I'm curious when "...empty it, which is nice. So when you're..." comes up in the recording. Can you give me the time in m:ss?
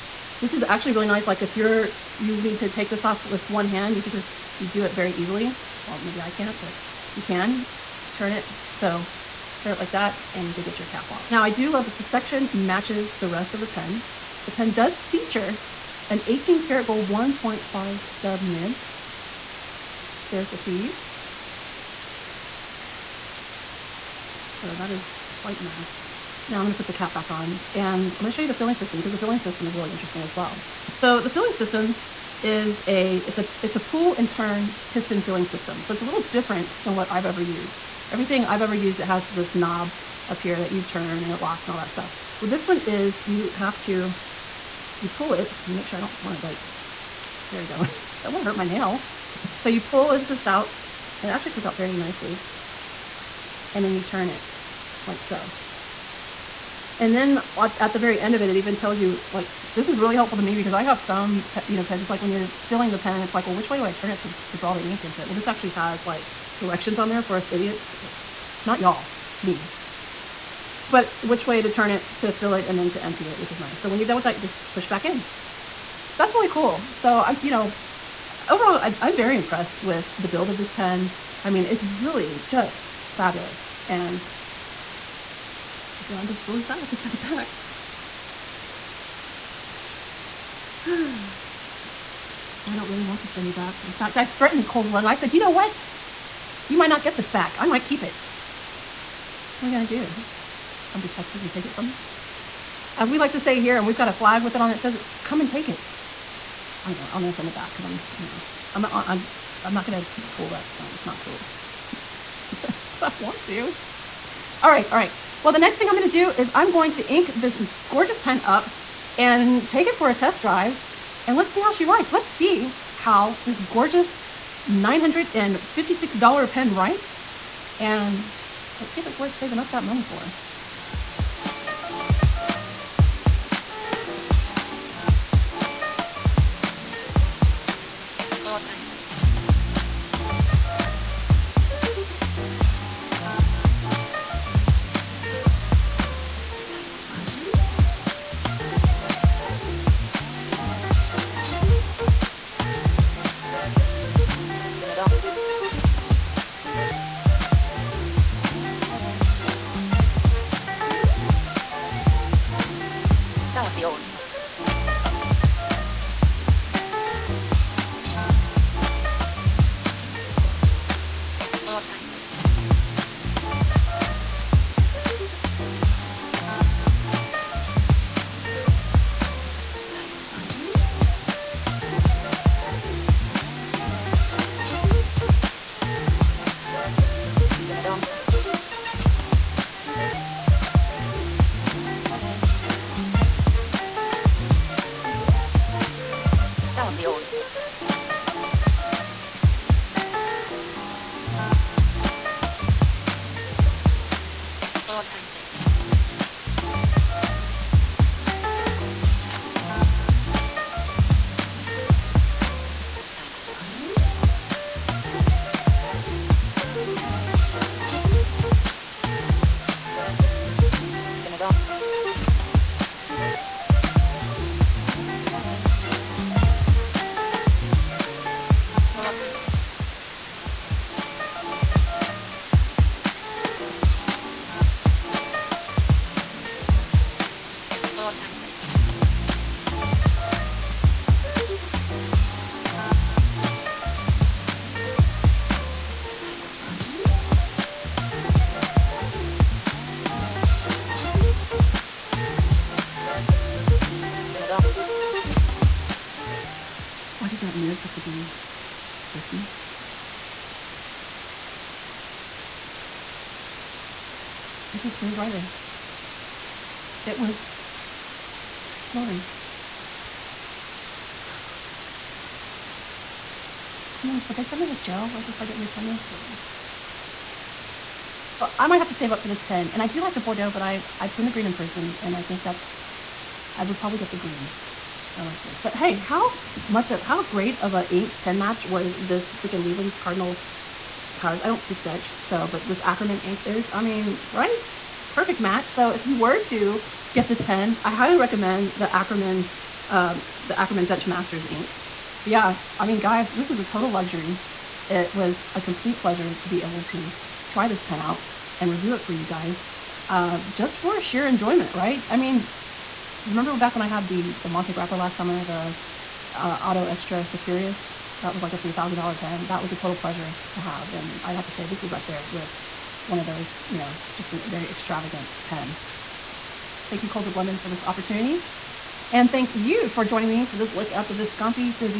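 1:13.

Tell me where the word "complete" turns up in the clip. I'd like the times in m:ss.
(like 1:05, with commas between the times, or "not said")
5:05.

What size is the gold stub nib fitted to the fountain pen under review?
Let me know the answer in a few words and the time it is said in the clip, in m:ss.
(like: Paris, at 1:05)
1.5, at 0:17.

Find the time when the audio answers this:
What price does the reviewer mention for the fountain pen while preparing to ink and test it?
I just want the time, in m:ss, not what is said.
2:04.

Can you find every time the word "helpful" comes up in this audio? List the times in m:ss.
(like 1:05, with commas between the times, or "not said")
1:00.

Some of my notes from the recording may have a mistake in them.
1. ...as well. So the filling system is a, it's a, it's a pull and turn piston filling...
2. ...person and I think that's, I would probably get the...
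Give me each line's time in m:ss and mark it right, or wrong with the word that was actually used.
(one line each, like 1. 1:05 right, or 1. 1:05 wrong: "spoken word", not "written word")
1. 0:30 right
2. 4:41 right.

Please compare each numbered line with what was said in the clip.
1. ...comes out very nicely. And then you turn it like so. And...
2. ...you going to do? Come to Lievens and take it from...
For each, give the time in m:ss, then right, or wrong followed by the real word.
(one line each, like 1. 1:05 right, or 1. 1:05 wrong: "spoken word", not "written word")
1. 0:51 right
2. 1:39 wrong: "Texas", not "Lievens".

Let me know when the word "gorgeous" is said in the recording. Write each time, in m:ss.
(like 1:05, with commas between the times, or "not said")
1:57, 2:03.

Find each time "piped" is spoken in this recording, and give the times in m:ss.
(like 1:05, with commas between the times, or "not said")
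not said.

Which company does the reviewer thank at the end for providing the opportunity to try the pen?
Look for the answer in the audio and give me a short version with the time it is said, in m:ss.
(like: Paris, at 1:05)
Coles of London, at 5:27.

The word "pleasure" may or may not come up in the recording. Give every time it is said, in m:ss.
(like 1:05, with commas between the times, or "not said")
5:05, 5:19.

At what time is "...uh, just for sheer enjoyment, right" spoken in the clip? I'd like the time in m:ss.
5:10.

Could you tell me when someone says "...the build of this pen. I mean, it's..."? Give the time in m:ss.
1:20.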